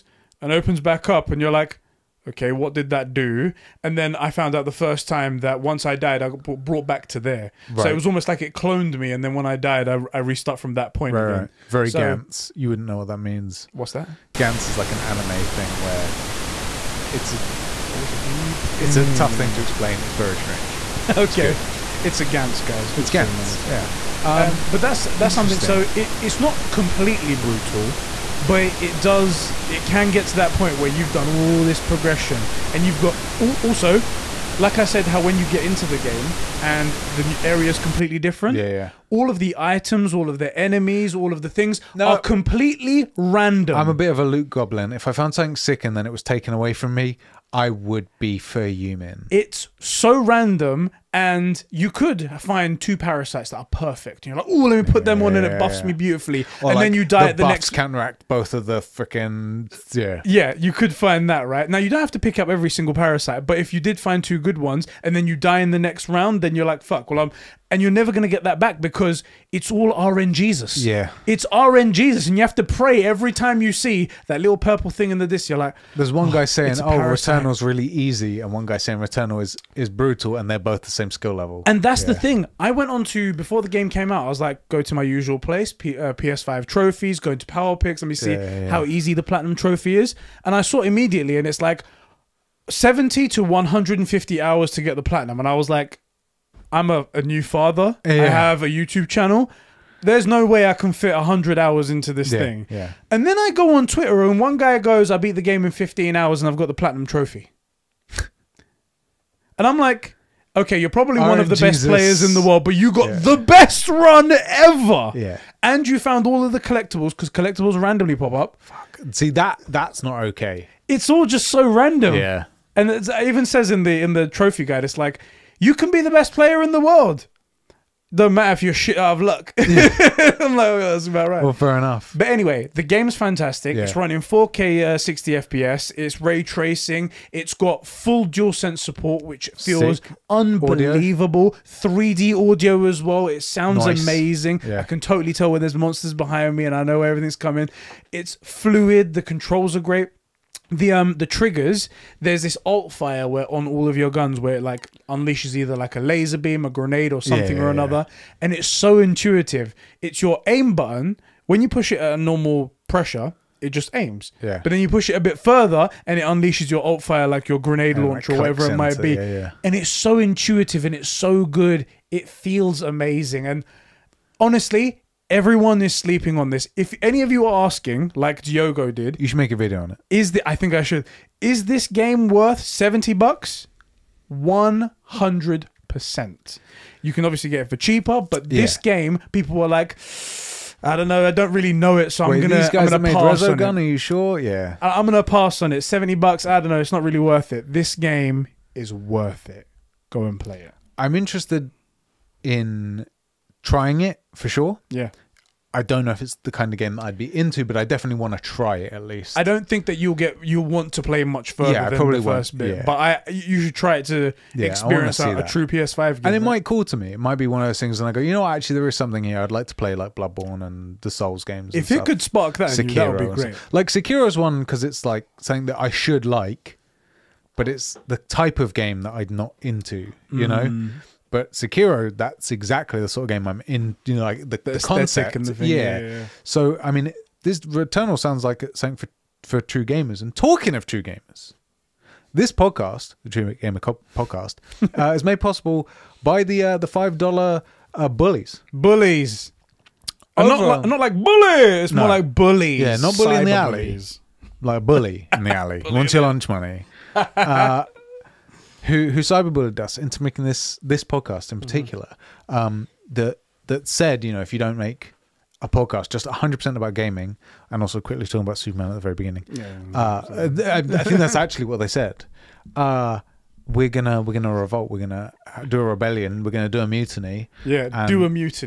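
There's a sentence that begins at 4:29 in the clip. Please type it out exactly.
Yeah, uh, I, I, think that's actually what they said.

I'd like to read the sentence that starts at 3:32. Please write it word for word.
but I you should try it to yeah, experience a, a true PS5 game.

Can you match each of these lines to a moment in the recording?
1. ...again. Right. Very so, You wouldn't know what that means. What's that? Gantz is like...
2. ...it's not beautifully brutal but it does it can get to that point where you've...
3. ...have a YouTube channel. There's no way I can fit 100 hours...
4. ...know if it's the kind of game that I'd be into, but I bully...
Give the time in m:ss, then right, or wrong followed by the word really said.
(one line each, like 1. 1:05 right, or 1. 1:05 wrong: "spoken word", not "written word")
1. 0:11 right
2. 0:26 wrong: "completely", not "beautifully"
3. 1:38 right
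4. 3:26 wrong: "definitely", not "bully".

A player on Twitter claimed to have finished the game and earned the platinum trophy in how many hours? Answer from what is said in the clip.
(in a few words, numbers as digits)
15.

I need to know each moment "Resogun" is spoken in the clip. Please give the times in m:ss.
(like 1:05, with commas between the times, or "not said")
3:13.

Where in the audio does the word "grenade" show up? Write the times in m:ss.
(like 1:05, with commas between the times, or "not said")
2:36, 2:47.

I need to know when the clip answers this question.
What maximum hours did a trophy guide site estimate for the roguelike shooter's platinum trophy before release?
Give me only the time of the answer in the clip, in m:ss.
1:33.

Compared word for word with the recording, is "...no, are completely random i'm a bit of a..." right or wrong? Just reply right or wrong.
right.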